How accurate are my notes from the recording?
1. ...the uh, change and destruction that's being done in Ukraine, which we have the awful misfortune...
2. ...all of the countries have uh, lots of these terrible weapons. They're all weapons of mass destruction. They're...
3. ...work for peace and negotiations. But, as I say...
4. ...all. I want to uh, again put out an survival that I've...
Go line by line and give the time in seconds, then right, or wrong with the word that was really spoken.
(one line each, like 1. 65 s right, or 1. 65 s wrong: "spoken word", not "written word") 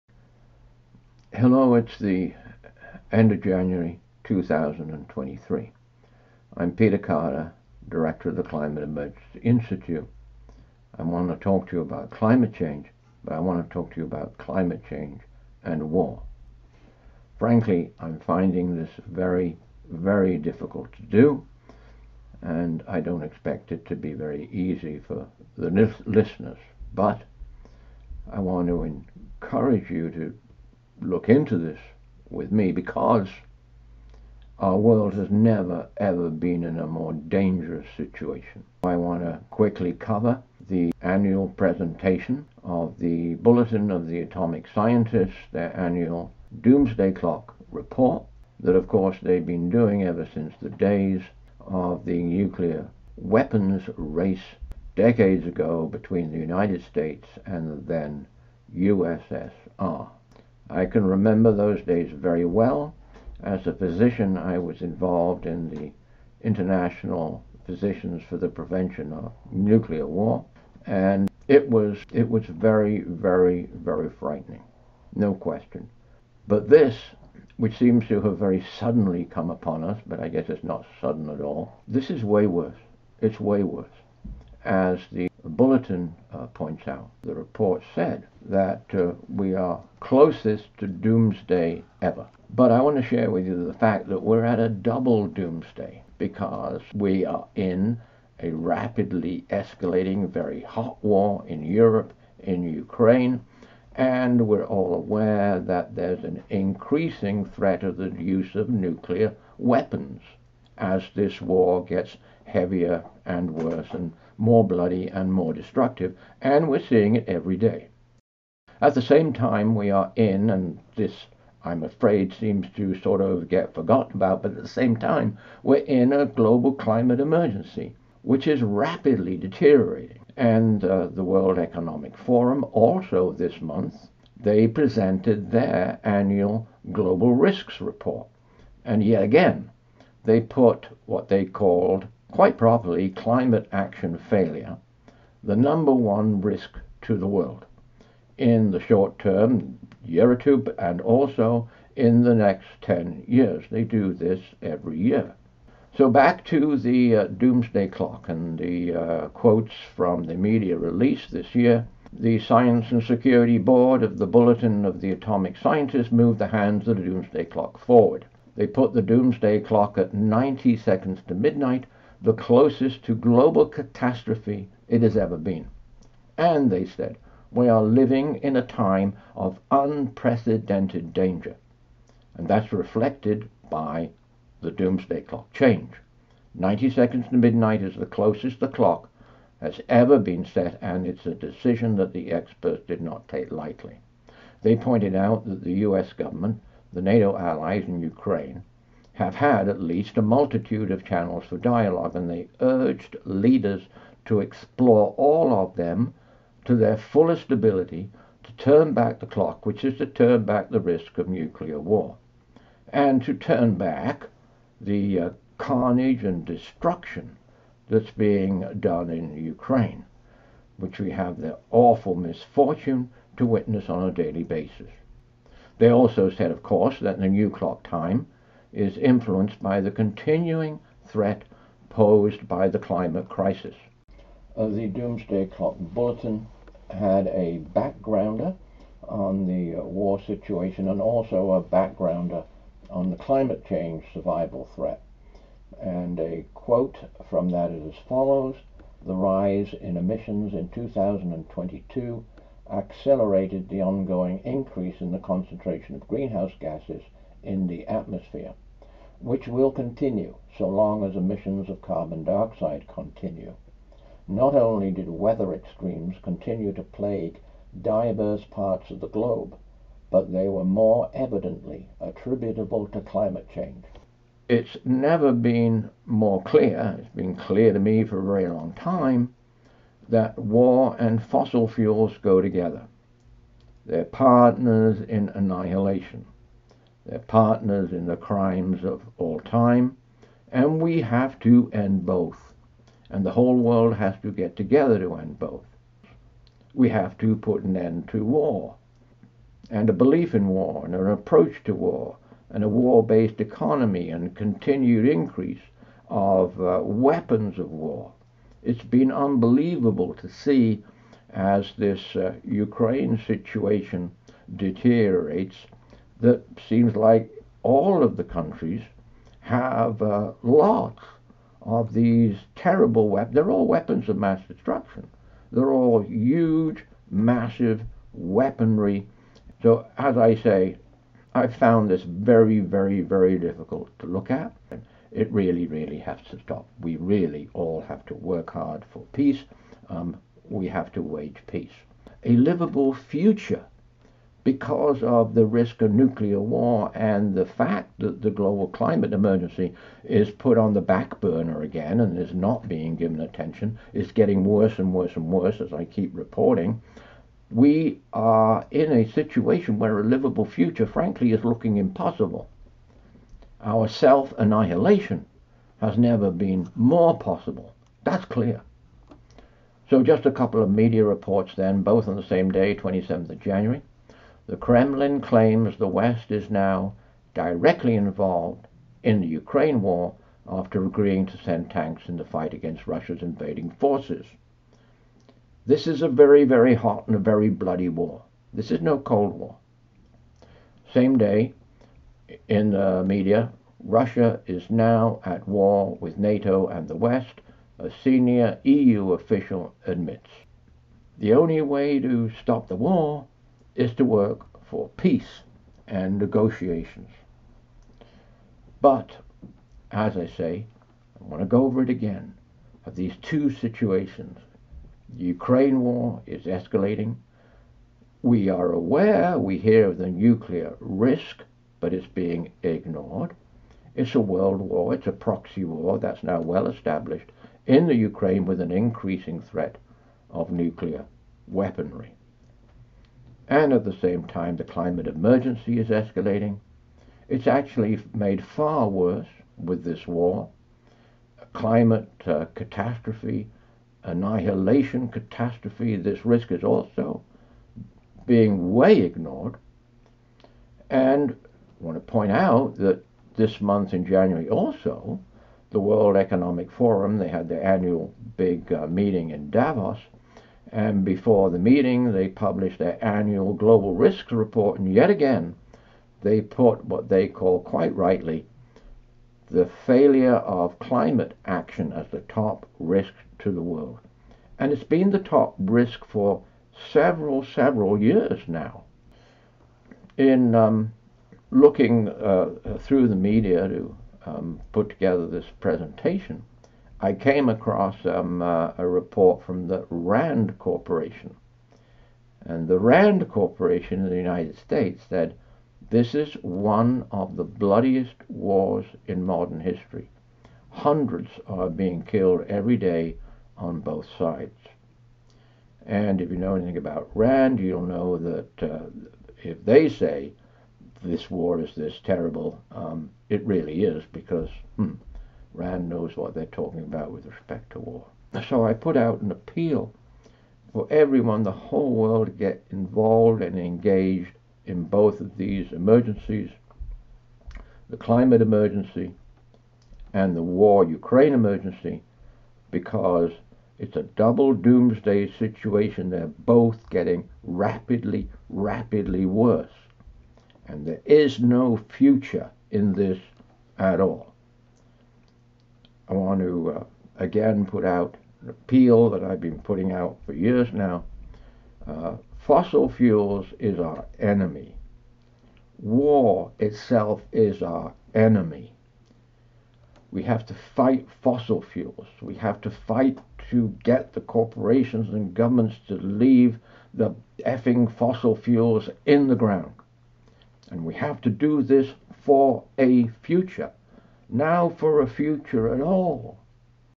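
1. 214 s wrong: "carnage", not "change"
2. 317 s right
3. 404 s right
4. 543 s wrong: "appeal", not "survival".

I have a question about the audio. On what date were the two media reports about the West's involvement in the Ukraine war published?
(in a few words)
27th of January.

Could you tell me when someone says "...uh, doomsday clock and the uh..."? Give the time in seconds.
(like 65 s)
157 s.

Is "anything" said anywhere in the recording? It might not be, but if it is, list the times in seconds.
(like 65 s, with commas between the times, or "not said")
506 s.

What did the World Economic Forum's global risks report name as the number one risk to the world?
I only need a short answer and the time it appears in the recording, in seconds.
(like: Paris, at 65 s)
Climate action failure, at 143 s.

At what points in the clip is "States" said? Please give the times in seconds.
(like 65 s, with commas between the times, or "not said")
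56 s, 494 s.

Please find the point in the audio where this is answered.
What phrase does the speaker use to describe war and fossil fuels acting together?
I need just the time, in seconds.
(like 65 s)
284 s.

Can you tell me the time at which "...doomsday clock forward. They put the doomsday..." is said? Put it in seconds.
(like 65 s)
167 s.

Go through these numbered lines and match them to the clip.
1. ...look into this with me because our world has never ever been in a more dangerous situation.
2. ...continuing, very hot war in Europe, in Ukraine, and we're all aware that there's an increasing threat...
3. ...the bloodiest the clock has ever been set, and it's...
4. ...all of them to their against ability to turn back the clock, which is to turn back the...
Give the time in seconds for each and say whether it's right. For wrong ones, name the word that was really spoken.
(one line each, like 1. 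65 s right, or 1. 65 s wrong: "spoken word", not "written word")
1. 31 s right
2. 99 s wrong: "escalating", not "continuing"
3. 187 s wrong: "closest", not "bloodiest"
4. 205 s wrong: "fullest", not "against".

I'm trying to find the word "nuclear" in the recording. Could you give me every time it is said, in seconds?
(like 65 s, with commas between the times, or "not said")
52 s, 69 s, 108 s, 211 s, 345 s, 420 s, 430 s.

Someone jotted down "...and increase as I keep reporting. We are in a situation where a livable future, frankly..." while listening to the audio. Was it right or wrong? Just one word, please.
wrong.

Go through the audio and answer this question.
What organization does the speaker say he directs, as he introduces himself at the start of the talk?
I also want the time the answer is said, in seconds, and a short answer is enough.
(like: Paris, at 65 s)
Climate Emergency Institute, at 8 s.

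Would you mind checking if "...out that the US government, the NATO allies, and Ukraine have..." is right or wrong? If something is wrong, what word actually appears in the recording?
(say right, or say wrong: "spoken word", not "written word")
right.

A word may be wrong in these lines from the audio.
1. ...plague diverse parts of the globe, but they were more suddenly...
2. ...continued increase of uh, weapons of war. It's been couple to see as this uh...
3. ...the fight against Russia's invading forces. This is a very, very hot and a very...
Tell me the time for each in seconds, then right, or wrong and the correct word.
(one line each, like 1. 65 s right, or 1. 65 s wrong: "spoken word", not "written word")
1. 266 s wrong: "evidently", not "suddenly"
2. 304 s wrong: "unbelievable", not "couple"
3. 382 s right.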